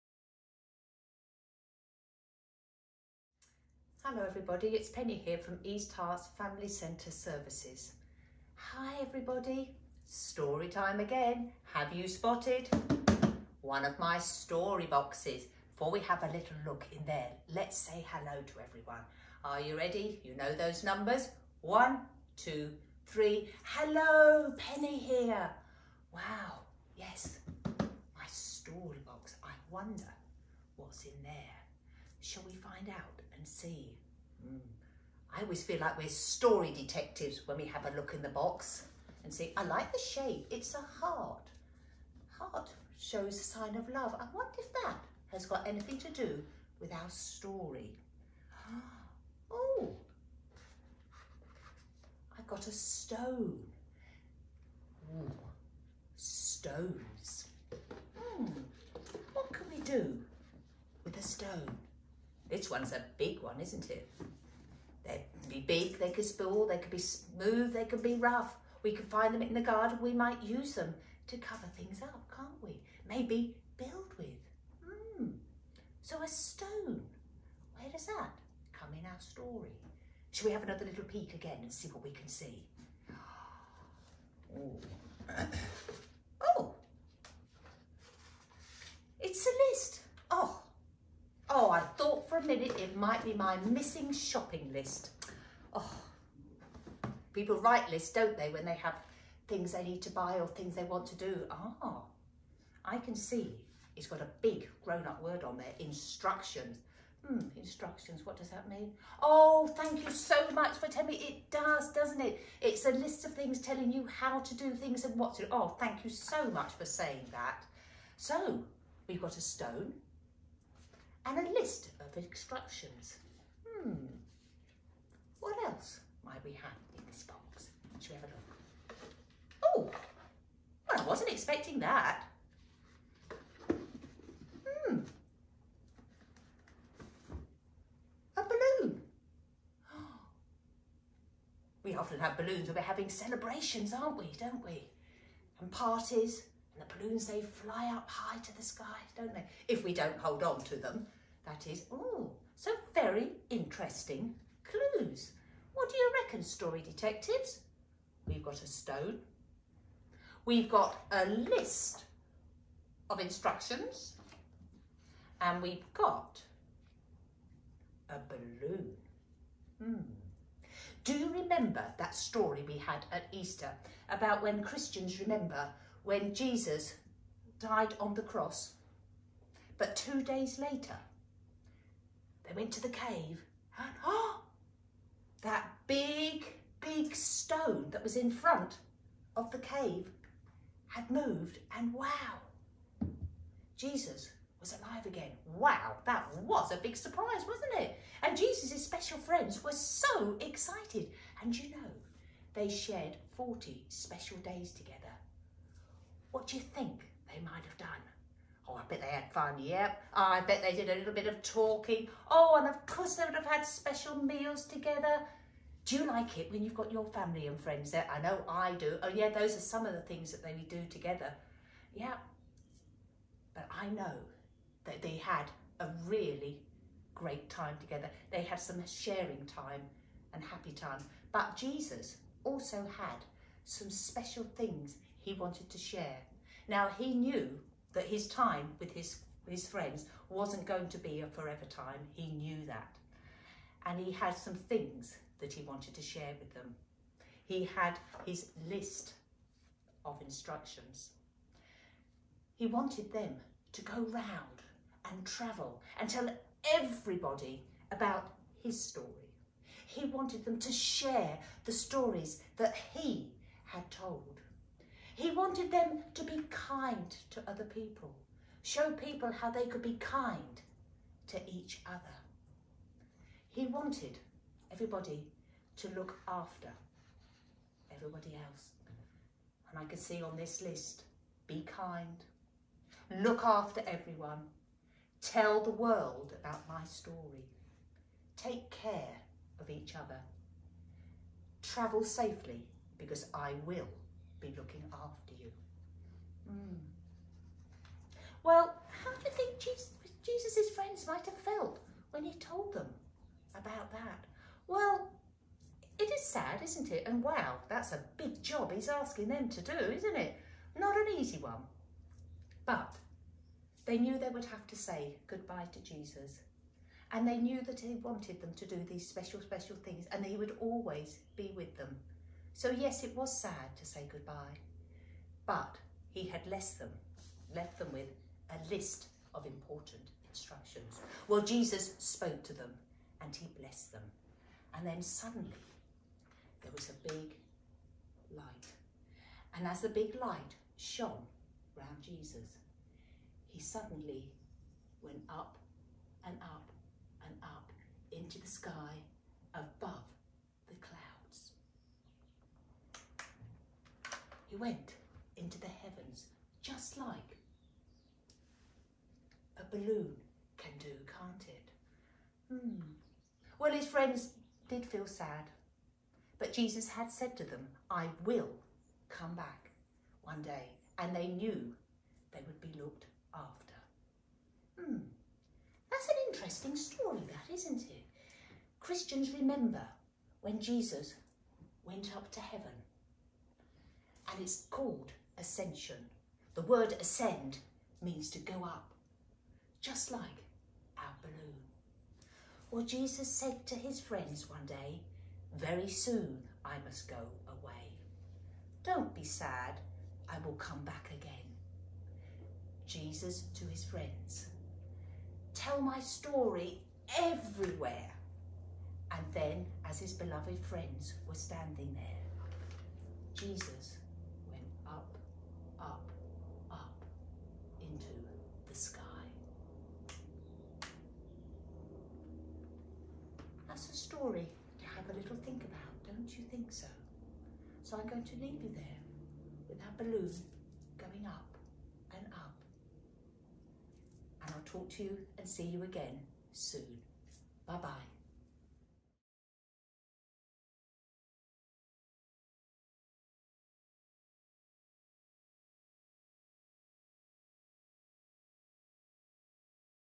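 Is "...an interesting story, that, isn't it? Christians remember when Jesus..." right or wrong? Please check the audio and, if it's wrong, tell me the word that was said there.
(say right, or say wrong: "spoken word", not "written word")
right.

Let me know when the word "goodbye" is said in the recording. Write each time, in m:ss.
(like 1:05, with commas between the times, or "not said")
5:15, 5:24.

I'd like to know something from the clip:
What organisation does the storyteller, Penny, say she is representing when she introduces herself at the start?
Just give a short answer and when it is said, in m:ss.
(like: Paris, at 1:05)
East Herts Family Centre Services, at 0:05.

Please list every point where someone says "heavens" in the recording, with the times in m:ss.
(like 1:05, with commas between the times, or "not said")
5:55, 6:22.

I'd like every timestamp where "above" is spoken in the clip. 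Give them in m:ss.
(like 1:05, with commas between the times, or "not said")
5:49.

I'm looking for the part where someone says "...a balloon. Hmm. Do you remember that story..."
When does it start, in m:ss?
2:48.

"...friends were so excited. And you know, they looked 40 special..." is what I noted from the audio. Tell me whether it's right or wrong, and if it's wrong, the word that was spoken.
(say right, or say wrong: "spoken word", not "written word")
wrong: "shared", not "looked".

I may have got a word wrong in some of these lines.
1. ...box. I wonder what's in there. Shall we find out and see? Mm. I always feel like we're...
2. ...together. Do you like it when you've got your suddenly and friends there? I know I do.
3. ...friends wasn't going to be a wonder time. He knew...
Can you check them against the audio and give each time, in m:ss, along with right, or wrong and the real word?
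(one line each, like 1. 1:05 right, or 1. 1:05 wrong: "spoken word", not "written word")
1. 0:29 right
2. 3:34 wrong: "family", not "suddenly"
3. 3:59 wrong: "forever", not "wonder".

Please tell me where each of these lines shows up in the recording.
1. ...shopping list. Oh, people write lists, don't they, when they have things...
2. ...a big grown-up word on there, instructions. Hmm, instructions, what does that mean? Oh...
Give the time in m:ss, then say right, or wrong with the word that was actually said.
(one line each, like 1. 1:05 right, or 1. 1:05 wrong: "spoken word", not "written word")
1. 1:34 right
2. 1:44 right.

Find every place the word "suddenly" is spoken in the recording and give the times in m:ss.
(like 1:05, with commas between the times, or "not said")
5:35, 5:43.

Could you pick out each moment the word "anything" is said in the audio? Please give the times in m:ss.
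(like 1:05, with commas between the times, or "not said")
0:45.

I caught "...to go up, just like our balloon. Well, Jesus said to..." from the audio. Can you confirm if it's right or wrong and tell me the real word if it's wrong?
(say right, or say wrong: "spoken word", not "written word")
right.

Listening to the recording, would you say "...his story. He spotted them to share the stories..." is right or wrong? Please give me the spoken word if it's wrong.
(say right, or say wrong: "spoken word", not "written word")
wrong: "wanted", not "spotted".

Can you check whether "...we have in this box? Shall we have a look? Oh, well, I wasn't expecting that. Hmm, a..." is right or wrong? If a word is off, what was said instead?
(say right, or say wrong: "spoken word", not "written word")
right.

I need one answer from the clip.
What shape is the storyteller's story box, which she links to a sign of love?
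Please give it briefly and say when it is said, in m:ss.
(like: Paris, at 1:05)
A heart, at 0:40.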